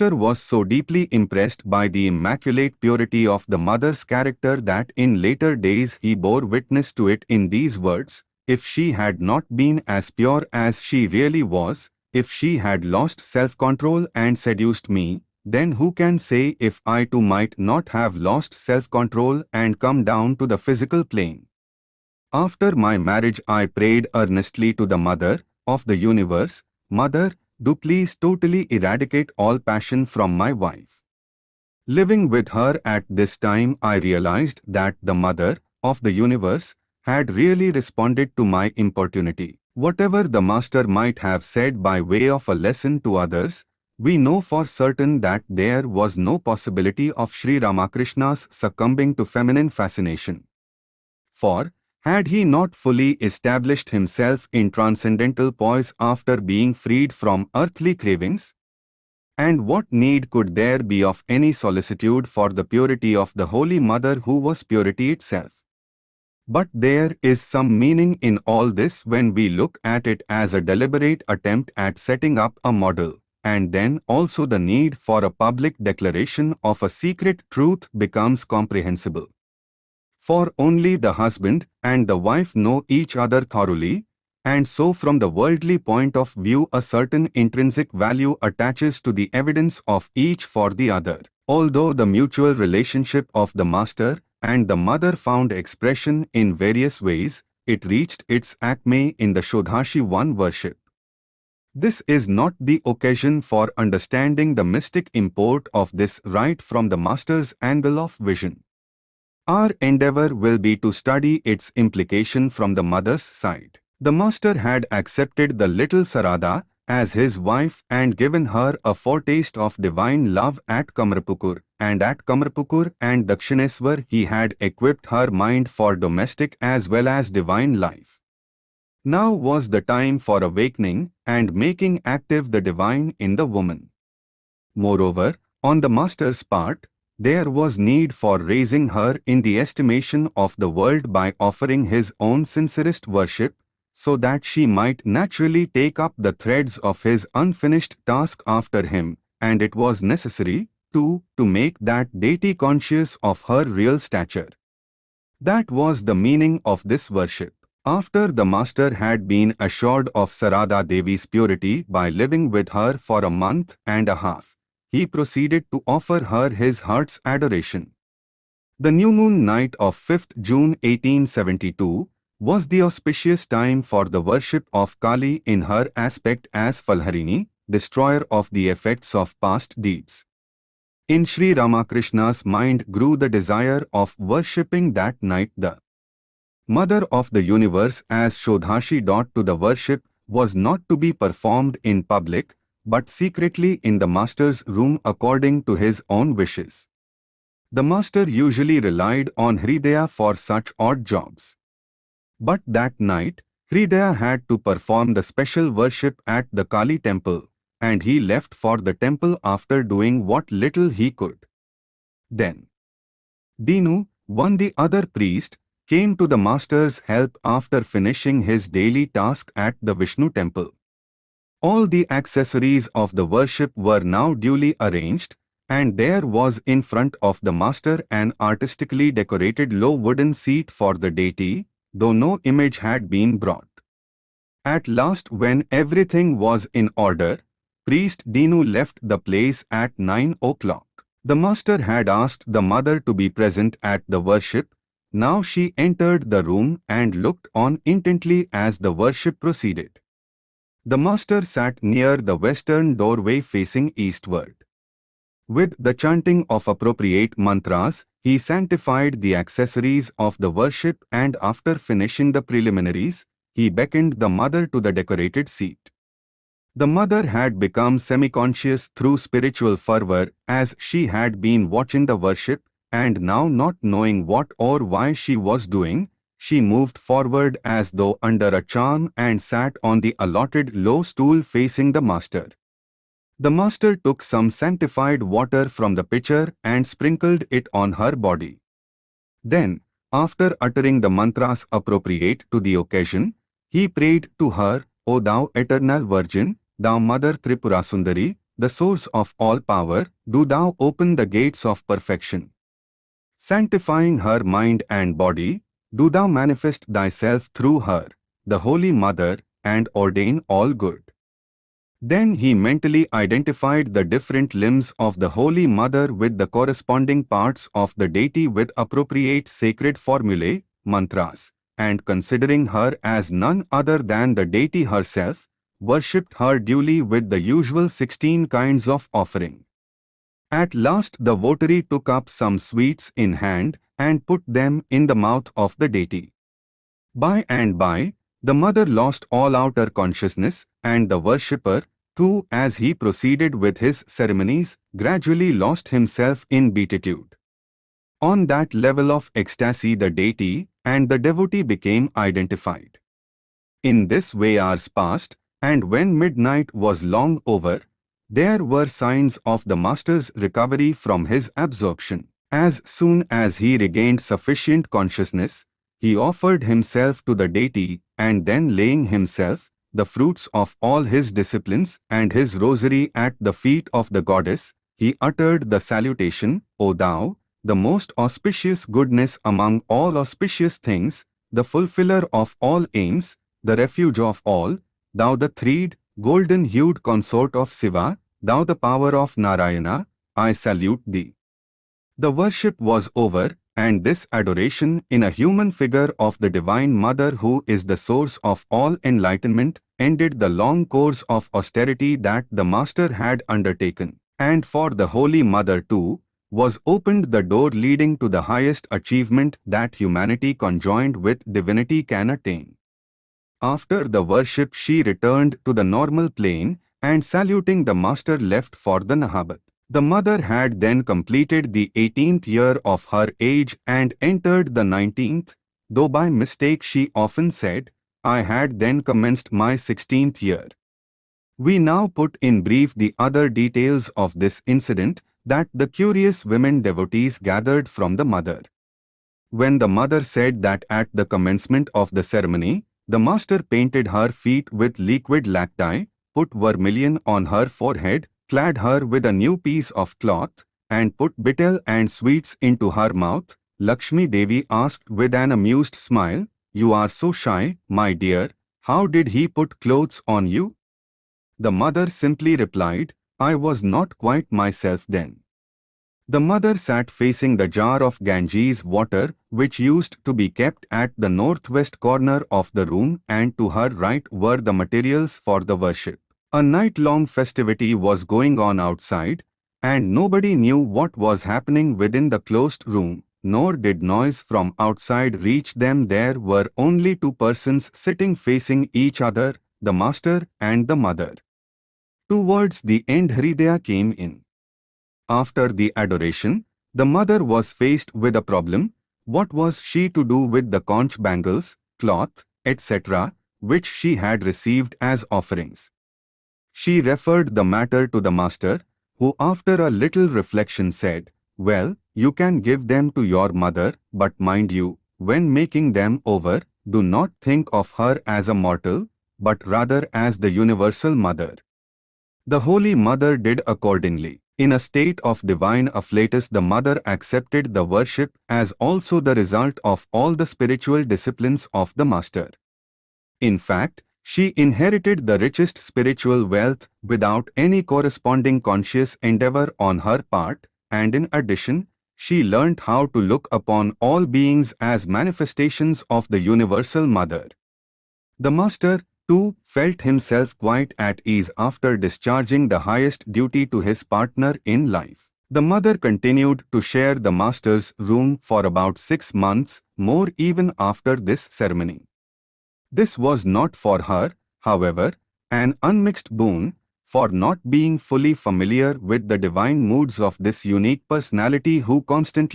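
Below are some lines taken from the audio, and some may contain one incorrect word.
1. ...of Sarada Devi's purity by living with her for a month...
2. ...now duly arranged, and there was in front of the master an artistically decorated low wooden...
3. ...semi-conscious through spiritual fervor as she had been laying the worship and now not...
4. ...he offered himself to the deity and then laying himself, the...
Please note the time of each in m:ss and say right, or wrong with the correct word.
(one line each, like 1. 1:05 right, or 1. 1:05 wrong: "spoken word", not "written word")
1. 2:40 right
2. 3:44 right
3. 4:27 wrong: "watching", not "laying"
4. 6:05 right.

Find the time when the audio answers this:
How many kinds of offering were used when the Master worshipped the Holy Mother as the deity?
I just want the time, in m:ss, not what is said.
5:27.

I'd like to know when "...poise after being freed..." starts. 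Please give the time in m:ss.
0:55.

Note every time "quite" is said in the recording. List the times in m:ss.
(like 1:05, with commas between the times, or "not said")
7:44, 9:10.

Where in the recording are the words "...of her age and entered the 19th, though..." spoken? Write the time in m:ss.
7:02.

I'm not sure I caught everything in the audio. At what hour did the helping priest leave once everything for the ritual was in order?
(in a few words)
9 o'clock.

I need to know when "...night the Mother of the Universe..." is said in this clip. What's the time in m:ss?
3:05.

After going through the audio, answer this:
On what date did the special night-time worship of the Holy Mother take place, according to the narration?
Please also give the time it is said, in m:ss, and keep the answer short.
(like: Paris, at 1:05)
5th June 1872, at 2:50.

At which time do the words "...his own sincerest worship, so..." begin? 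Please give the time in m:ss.
2:21.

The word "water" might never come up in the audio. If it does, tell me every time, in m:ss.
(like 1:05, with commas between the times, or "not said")
4:45, 7:48.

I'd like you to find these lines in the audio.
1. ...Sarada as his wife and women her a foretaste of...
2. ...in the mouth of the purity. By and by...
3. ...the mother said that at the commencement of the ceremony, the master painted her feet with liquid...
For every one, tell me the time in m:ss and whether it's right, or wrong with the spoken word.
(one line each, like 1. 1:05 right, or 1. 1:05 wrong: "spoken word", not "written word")
1. 1:56 wrong: "given", not "women"
2. 5:34 wrong: "deity", not "purity"
3. 7:19 right.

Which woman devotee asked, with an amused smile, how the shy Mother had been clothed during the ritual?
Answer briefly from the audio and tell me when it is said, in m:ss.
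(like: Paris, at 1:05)
Lakshmi Devi, at 7:33.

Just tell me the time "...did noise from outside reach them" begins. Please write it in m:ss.
8:03.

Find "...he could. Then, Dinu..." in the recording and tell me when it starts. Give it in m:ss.
3:30.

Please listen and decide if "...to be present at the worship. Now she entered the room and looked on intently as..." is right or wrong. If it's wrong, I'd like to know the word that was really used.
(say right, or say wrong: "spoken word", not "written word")
right.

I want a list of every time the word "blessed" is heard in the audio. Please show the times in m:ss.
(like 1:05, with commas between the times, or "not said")
not said.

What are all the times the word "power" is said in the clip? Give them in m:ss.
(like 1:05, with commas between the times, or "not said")
4:59, 6:28.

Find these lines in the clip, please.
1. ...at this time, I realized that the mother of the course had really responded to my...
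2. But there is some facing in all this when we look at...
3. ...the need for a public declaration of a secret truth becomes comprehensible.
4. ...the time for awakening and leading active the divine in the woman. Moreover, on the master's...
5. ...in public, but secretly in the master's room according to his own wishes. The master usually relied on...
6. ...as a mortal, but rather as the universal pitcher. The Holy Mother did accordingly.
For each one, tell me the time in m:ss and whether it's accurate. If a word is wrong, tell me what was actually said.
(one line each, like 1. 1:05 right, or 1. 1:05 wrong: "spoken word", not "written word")
1. 0:32 wrong: "universe", not "course"
2. 1:06 wrong: "meaning", not "facing"
3. 1:14 right
4. 2:09 wrong: "making", not "leading"
5. 3:11 right
6. 8:38 wrong: "mother", not "pitcher".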